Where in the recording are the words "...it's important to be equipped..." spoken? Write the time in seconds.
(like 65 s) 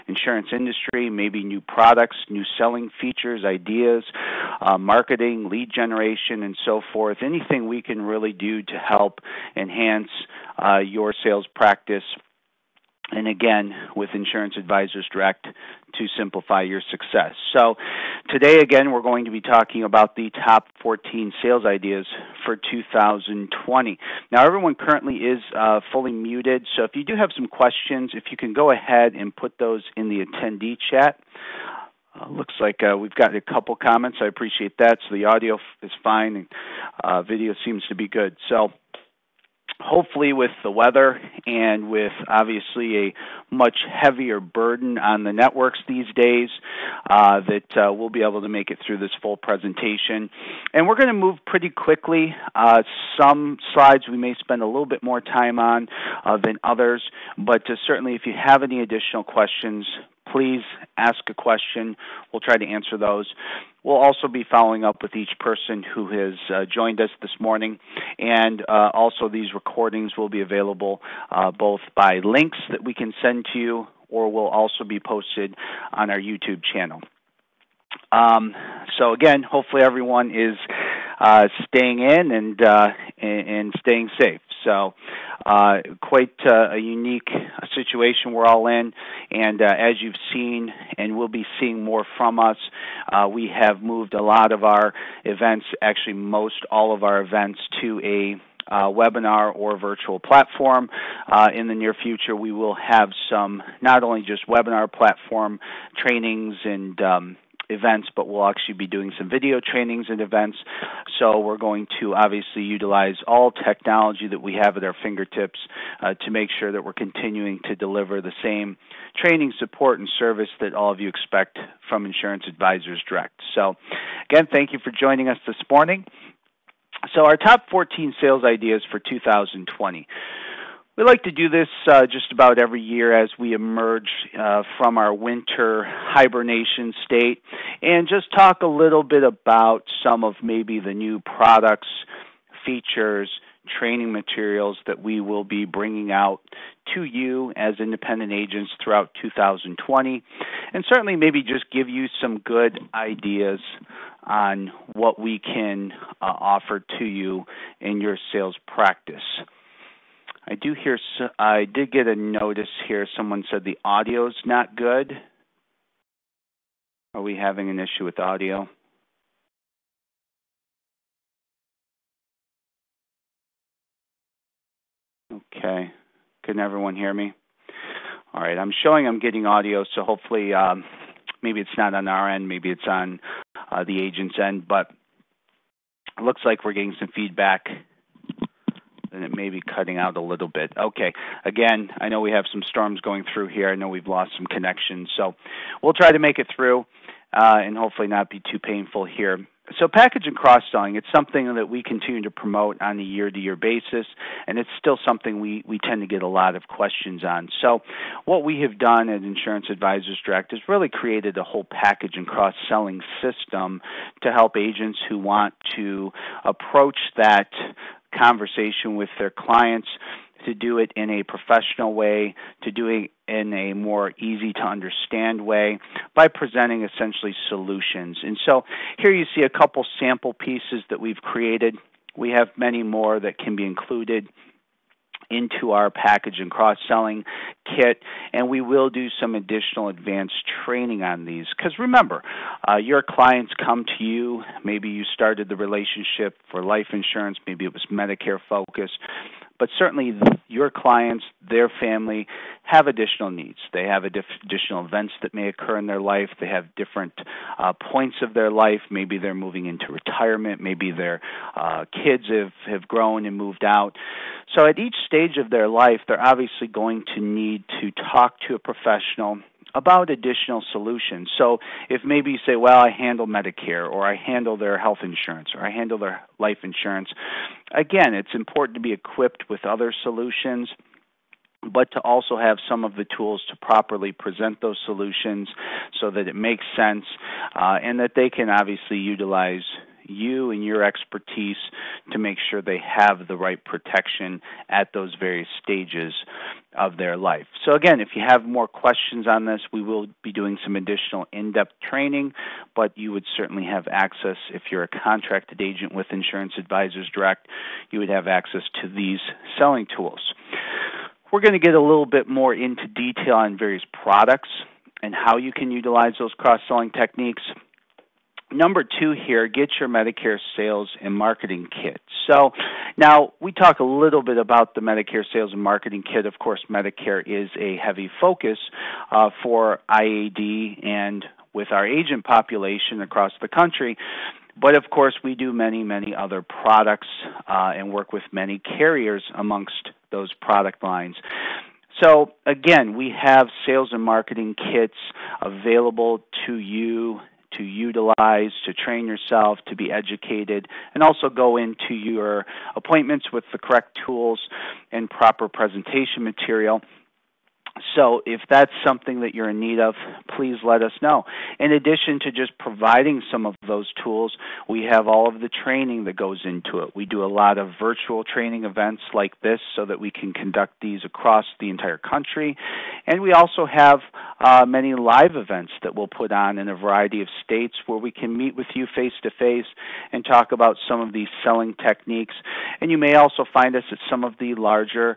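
278 s.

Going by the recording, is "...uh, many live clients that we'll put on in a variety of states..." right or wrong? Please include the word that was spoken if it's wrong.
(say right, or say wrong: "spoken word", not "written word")
wrong: "events", not "clients".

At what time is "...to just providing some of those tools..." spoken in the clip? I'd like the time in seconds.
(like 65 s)
362 s.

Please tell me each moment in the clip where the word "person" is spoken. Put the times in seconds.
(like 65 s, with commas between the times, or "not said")
65 s.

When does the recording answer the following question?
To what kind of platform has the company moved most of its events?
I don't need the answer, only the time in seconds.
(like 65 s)
98 s.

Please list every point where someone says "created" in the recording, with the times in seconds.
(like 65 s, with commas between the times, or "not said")
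210 s, 231 s.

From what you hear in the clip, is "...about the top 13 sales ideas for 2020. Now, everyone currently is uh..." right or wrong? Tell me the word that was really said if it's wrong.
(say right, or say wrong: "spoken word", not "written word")
wrong: "14", not "13".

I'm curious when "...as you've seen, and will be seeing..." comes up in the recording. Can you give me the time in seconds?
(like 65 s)
89 s.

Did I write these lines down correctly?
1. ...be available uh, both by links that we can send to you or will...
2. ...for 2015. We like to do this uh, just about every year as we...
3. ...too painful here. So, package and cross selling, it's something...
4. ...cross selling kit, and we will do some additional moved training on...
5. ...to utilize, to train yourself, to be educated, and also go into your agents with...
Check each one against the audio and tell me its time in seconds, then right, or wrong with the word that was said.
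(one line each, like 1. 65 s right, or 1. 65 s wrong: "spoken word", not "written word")
1. 70 s right
2. 128 s wrong: "2020", not "2015"
3. 198 s right
4. 236 s wrong: "advanced", not "moved"
5. 347 s wrong: "appointments", not "agents".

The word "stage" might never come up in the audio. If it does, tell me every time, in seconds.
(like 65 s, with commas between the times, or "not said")
265 s, 295 s.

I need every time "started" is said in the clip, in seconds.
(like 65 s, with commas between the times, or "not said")
245 s.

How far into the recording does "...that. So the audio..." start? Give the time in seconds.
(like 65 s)
34 s.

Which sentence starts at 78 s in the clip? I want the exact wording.
Um, so, again, hopefully, everyone is uh, staying in and, uh, and, and staying safe.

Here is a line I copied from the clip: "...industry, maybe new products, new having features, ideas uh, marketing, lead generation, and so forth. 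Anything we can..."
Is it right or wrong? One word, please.
wrong.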